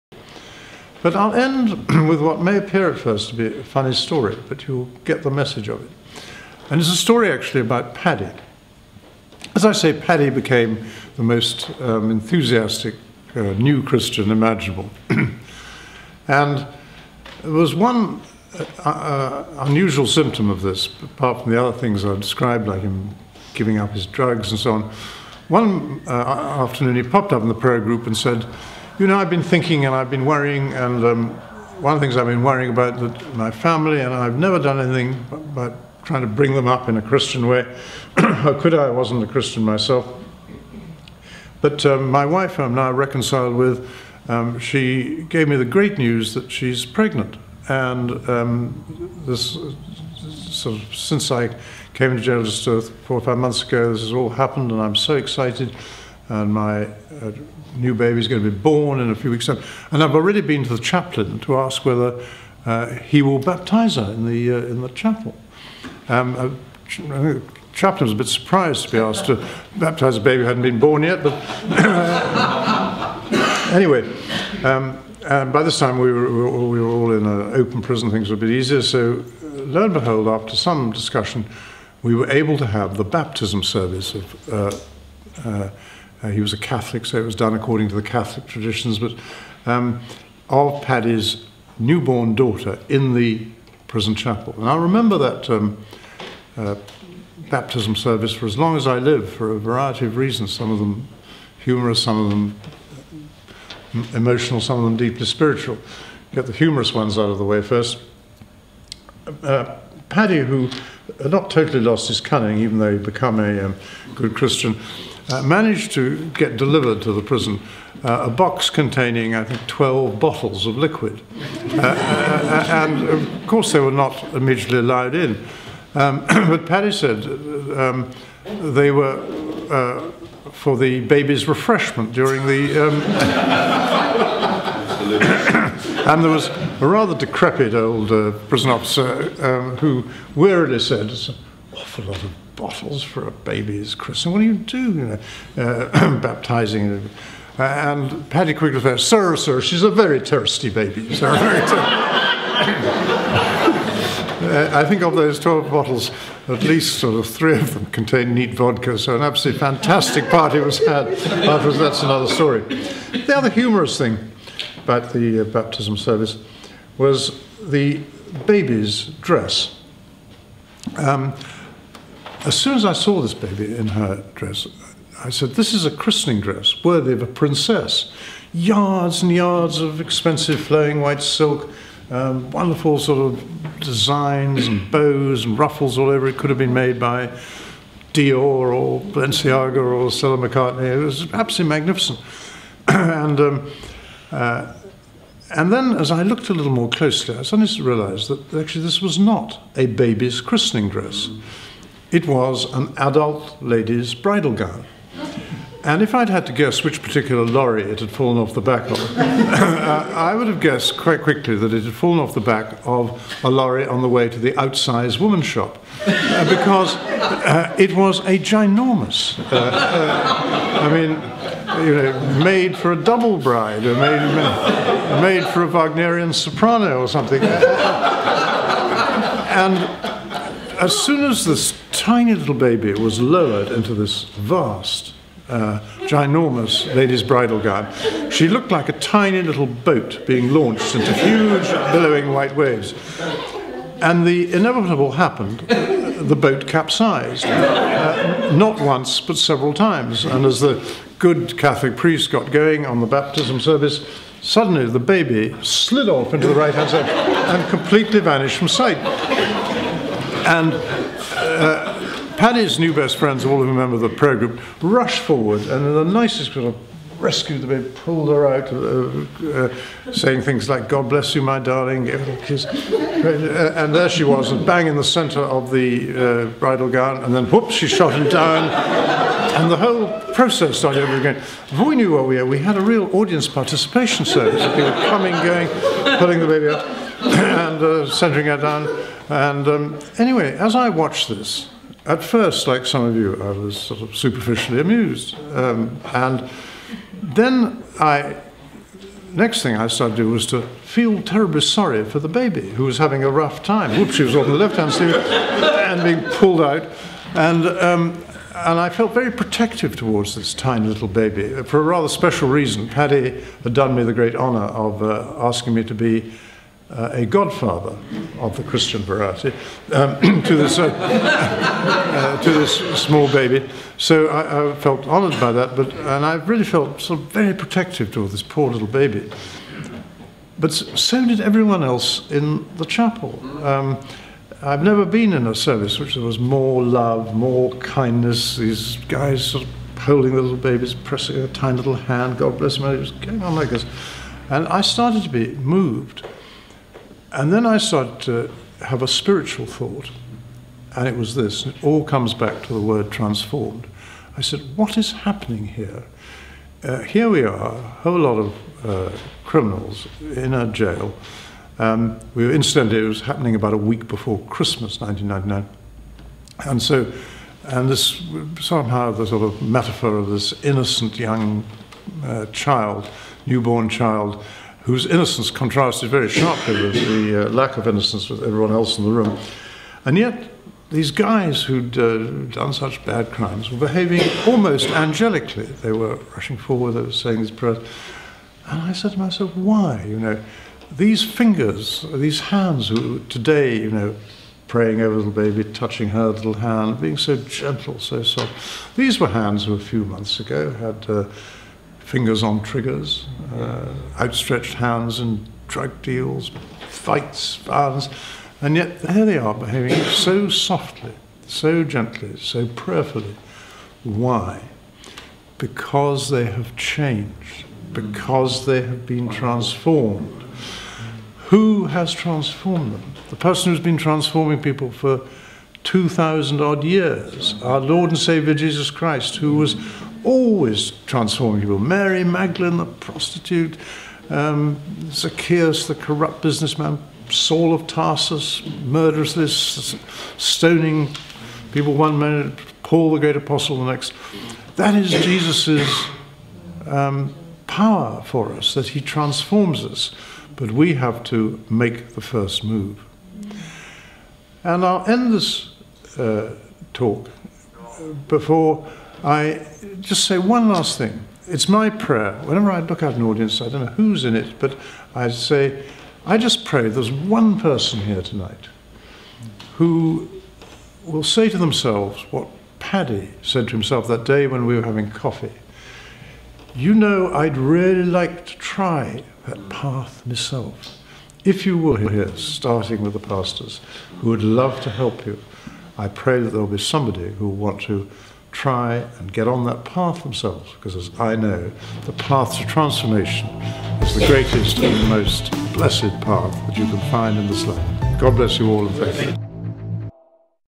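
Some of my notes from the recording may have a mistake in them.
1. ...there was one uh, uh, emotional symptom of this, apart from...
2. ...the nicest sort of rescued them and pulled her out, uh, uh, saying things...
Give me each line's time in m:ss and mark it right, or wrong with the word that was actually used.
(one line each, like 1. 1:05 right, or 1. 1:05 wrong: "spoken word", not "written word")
1. 0:17 wrong: "unusual", not "emotional"
2. 4:25 right.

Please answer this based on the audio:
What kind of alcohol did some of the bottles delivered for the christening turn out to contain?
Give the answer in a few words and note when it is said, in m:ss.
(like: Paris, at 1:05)
Neat vodka, at 2:38.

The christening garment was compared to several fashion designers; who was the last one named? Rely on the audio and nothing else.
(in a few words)
Stella McCartney.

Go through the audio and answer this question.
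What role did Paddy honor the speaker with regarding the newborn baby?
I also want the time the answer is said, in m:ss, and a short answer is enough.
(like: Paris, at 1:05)
Godfather, at 5:17.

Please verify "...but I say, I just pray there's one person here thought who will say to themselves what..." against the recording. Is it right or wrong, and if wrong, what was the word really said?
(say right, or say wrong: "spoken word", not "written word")
wrong: "tonight", not "thought".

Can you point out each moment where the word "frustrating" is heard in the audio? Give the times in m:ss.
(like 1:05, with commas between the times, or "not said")
not said.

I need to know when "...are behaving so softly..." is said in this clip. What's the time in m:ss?
6:49.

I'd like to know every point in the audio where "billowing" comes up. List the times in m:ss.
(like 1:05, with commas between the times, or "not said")
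4:01.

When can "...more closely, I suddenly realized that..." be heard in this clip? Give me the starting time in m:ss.
3:16.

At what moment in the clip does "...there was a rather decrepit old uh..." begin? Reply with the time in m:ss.
2:16.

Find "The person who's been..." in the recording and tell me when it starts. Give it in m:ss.
7:03.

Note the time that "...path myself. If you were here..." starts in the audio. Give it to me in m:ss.
7:59.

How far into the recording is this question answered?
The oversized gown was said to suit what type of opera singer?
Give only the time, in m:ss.
3:45.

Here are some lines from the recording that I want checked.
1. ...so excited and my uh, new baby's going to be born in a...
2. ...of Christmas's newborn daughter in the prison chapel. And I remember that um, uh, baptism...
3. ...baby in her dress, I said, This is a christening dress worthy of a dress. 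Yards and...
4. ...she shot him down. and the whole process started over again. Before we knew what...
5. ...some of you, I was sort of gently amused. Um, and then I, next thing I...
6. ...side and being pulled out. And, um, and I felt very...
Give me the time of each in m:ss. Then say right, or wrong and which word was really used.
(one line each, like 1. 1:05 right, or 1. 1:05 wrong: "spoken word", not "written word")
1. 0:54 right
2. 1:30 wrong: "Paddy", not "Christmas"
3. 2:53 wrong: "princess", not "dress"
4. 4:37 right
5. 4:52 wrong: "superficially", not "gently"
6. 5:04 right.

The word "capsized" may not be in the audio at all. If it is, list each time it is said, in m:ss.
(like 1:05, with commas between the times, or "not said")
4:06.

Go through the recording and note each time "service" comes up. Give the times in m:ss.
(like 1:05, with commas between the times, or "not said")
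1:23, 1:37, 2:45, 4:13, 4:44, 5:35.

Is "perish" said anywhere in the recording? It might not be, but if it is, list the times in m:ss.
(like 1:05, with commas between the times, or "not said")
not said.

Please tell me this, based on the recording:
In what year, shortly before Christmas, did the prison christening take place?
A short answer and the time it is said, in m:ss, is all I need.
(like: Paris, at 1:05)
1999, at 6:04.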